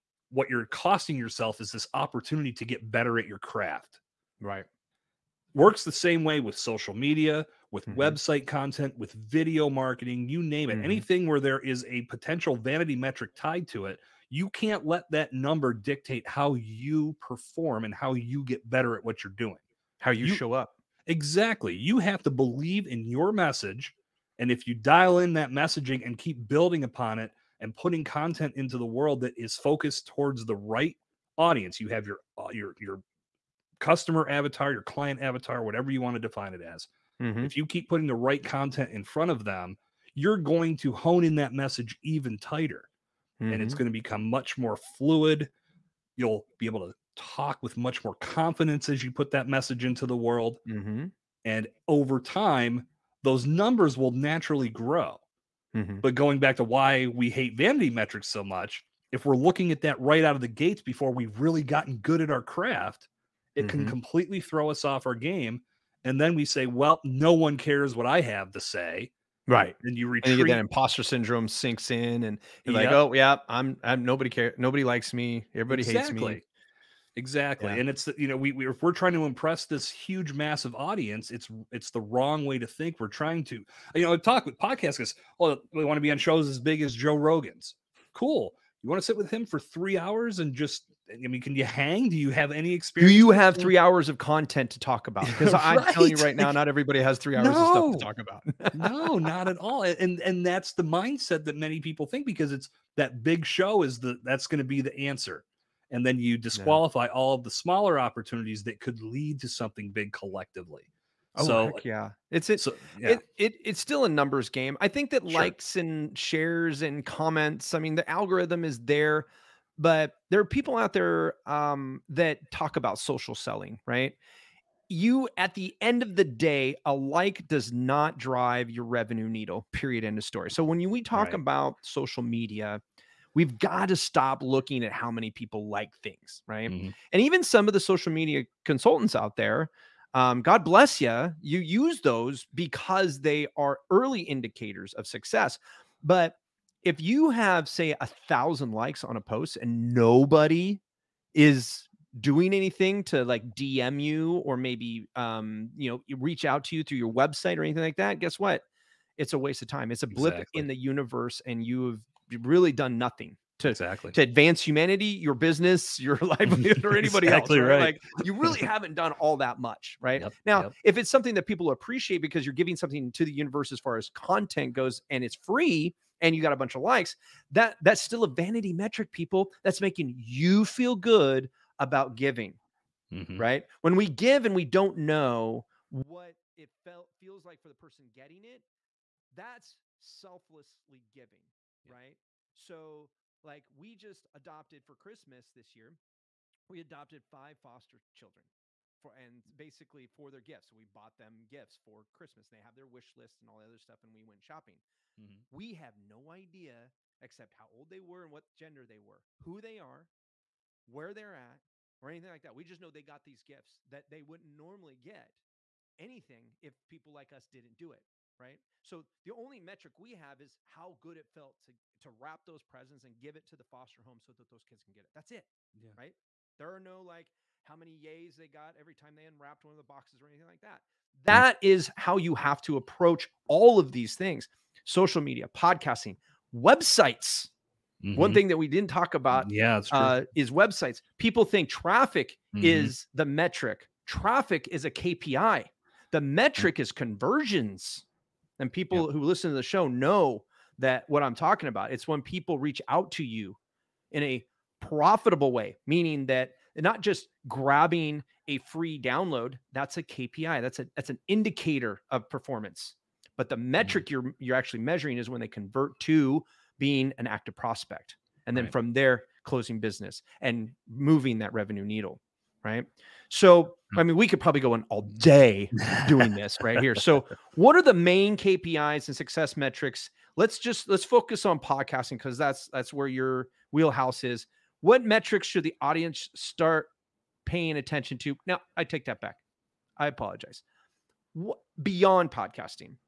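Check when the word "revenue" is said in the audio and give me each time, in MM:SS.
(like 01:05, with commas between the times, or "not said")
02:08, 04:31.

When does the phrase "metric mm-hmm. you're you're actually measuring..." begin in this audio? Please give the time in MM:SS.
04:23.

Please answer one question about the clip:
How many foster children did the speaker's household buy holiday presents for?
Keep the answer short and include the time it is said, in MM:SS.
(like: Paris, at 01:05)
5, at 03:17.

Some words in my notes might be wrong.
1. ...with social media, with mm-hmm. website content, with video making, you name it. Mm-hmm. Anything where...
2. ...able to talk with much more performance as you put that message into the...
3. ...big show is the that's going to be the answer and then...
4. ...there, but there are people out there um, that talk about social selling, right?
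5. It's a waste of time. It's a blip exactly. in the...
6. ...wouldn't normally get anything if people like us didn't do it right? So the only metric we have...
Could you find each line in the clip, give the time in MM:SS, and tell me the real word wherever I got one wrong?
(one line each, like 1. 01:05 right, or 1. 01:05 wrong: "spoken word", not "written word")
1. 00:06 wrong: "marketing", not "making"
2. 00:46 wrong: "confidence", not "performance"
3. 01:43 right
4. 01:58 right
5. 02:39 right
6. 03:34 right.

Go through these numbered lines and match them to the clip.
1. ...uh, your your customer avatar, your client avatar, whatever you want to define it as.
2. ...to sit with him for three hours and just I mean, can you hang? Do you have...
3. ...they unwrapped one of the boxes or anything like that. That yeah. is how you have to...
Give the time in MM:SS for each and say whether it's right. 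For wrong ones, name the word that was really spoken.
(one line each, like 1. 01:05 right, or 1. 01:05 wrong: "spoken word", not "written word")
1. 00:32 right
2. 01:28 right
3. 03:49 right.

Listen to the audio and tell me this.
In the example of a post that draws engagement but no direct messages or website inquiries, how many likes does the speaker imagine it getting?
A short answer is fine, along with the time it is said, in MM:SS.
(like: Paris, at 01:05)
1000, at 02:27.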